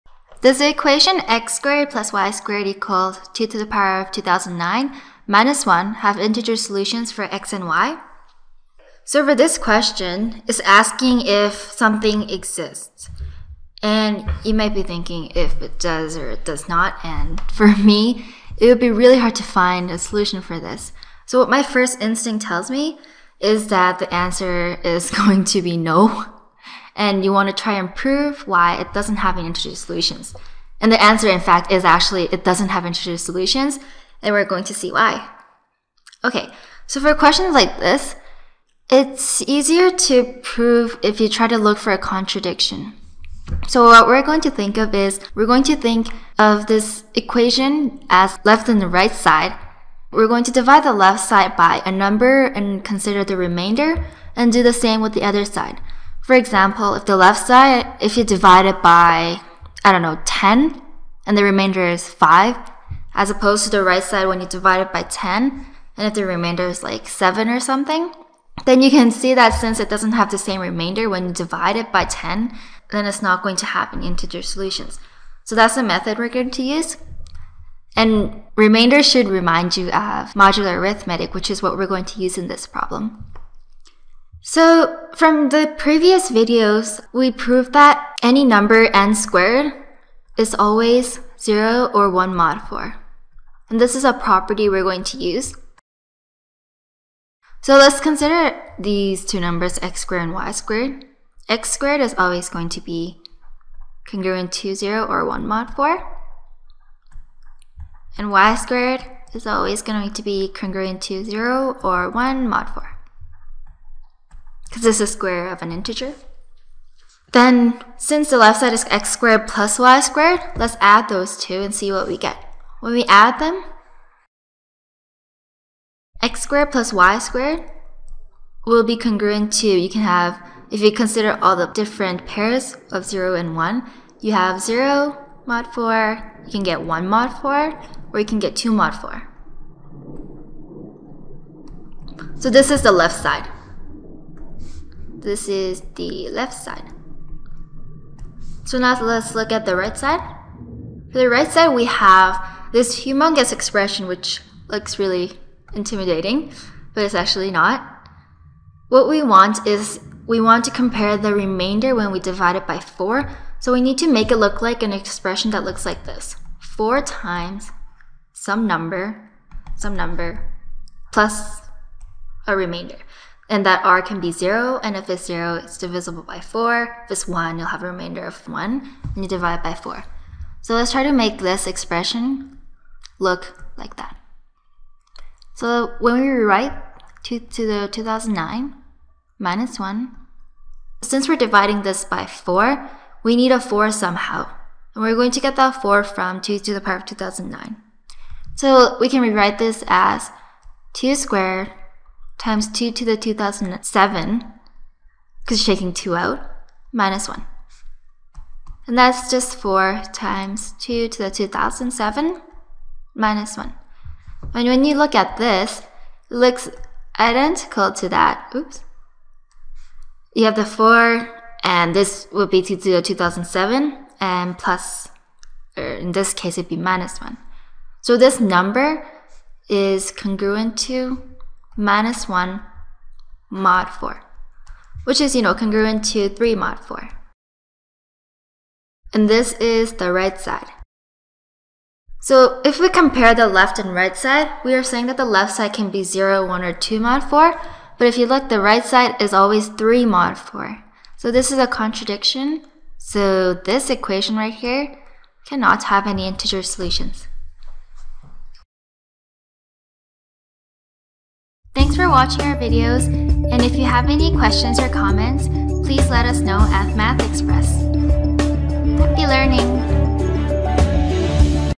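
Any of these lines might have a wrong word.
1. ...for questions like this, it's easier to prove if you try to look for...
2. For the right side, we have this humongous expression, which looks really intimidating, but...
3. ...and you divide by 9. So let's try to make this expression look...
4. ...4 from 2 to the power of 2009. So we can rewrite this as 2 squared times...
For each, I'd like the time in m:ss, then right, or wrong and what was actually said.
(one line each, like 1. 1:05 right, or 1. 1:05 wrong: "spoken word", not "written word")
1. 0:36 right
2. 2:31 right
3. 2:59 wrong: "4", not "9"
4. 3:15 right.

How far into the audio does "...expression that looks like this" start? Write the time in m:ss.
2:44.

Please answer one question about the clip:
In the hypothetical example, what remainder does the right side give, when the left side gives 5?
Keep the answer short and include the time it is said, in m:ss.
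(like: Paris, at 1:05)
7, at 1:07.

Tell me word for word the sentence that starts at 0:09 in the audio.
So for this question, it's asking if something exists.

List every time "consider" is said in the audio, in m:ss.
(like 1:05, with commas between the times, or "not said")
0:52, 1:38, 2:10.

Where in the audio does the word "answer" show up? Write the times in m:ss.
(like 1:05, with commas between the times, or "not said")
0:24, 0:31.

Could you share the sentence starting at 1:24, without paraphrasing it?
So from the previous videos, we proved that any number n squared is always 0 or 1 mod 4.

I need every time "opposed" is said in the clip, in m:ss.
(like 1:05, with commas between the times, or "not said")
1:03.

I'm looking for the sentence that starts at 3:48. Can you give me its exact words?
So this number is congruent to minus 1 mod 4, which is, you know, congruent to 3 mod 4.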